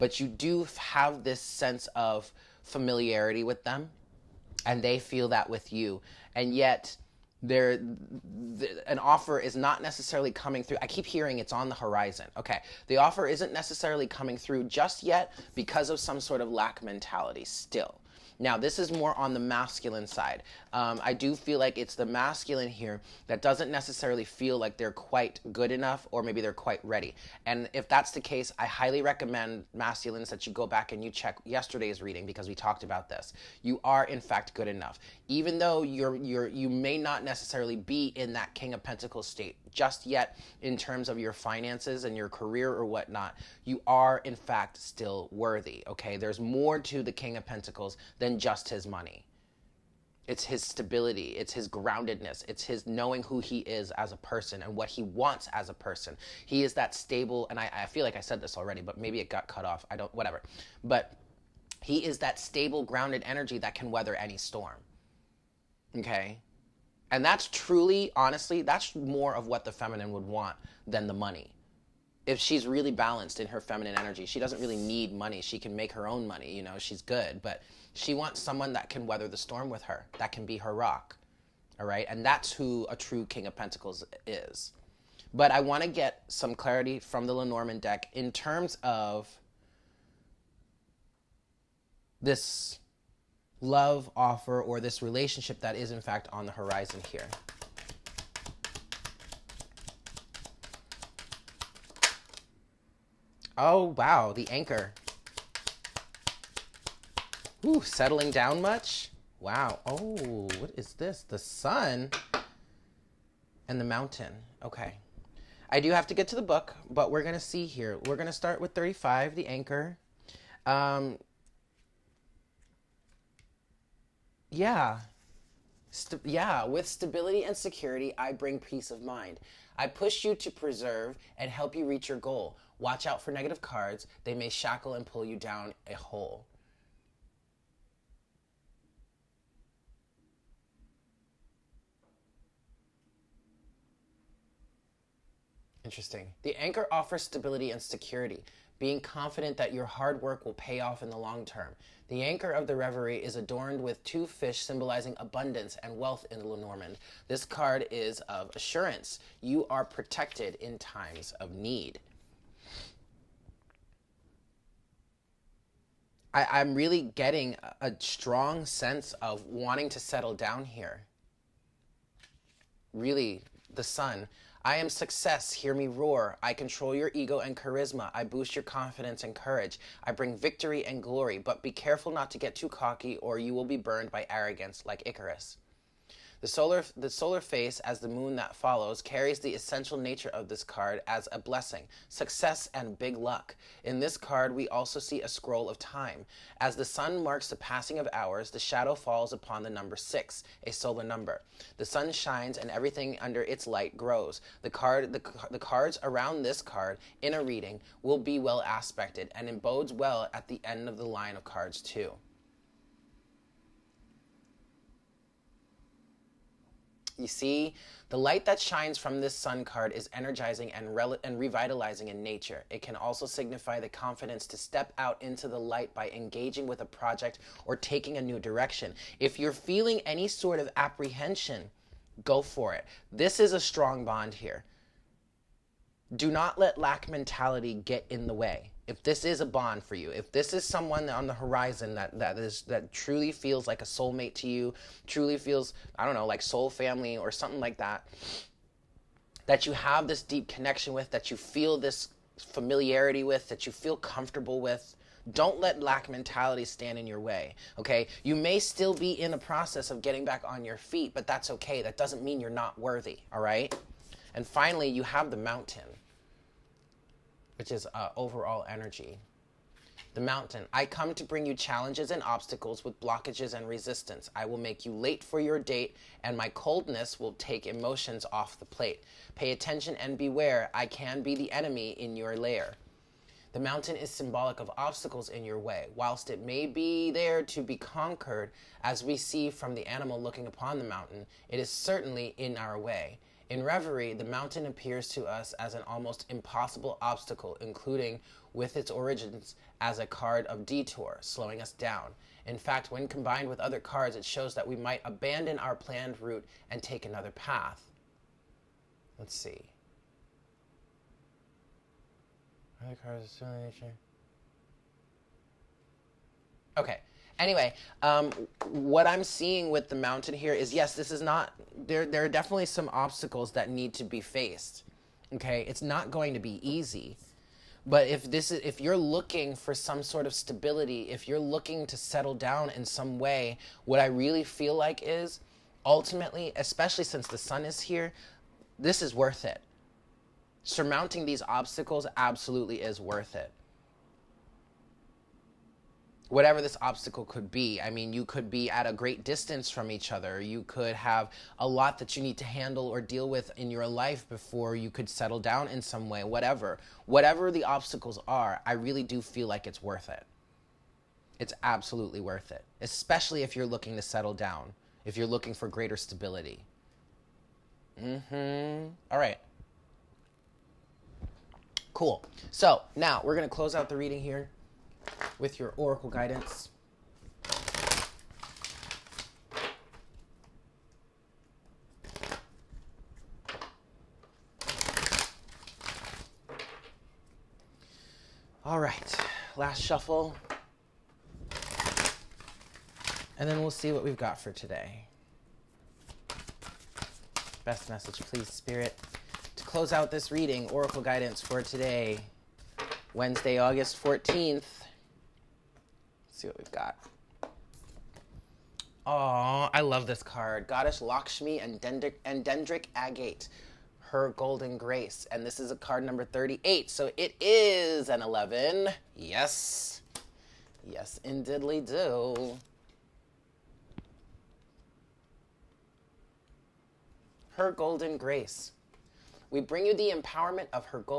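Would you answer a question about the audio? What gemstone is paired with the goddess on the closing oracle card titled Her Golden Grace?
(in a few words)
Dendritic Agate.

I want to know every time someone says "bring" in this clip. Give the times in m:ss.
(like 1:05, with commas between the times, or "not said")
2:08, 3:00, 4:31, 7:09.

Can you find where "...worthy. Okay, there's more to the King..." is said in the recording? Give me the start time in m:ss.
0:45.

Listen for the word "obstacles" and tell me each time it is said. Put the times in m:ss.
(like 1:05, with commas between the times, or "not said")
4:32, 4:44, 4:56, 5:22, 5:41, 5:46, 5:57.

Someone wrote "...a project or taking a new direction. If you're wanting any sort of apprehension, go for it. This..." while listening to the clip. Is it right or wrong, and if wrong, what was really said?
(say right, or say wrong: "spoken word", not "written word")
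wrong: "feeling", not "wanting".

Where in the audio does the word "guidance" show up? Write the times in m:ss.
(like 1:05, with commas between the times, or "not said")
6:16, 6:41.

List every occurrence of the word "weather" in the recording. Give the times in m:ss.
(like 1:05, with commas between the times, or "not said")
1:03, 1:19.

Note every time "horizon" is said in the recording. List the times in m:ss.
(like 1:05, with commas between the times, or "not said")
0:11, 1:36, 4:01.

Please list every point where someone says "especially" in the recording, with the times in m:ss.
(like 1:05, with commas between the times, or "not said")
5:36, 6:02.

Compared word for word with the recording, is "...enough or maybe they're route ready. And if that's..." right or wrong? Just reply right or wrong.
wrong.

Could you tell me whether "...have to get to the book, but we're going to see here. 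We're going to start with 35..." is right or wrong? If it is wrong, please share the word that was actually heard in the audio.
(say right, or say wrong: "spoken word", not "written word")
right.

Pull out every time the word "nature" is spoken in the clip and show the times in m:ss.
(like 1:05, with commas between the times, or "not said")
3:09, 3:42, 5:13.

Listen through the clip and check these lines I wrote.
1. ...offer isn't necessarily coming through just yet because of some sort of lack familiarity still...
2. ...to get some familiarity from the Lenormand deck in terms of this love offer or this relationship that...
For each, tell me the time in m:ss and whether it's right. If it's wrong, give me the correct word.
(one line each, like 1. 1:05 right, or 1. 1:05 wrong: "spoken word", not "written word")
1. 0:12 wrong: "mentality", not "familiarity"
2. 1:25 wrong: "clarity", not "familiarity".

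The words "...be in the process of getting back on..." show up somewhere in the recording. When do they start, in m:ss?
4:18.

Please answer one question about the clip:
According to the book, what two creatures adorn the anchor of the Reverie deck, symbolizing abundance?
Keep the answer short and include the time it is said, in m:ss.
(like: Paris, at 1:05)
two fish, at 2:34.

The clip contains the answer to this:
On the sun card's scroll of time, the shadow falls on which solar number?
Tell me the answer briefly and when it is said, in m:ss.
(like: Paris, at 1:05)
6, at 3:19.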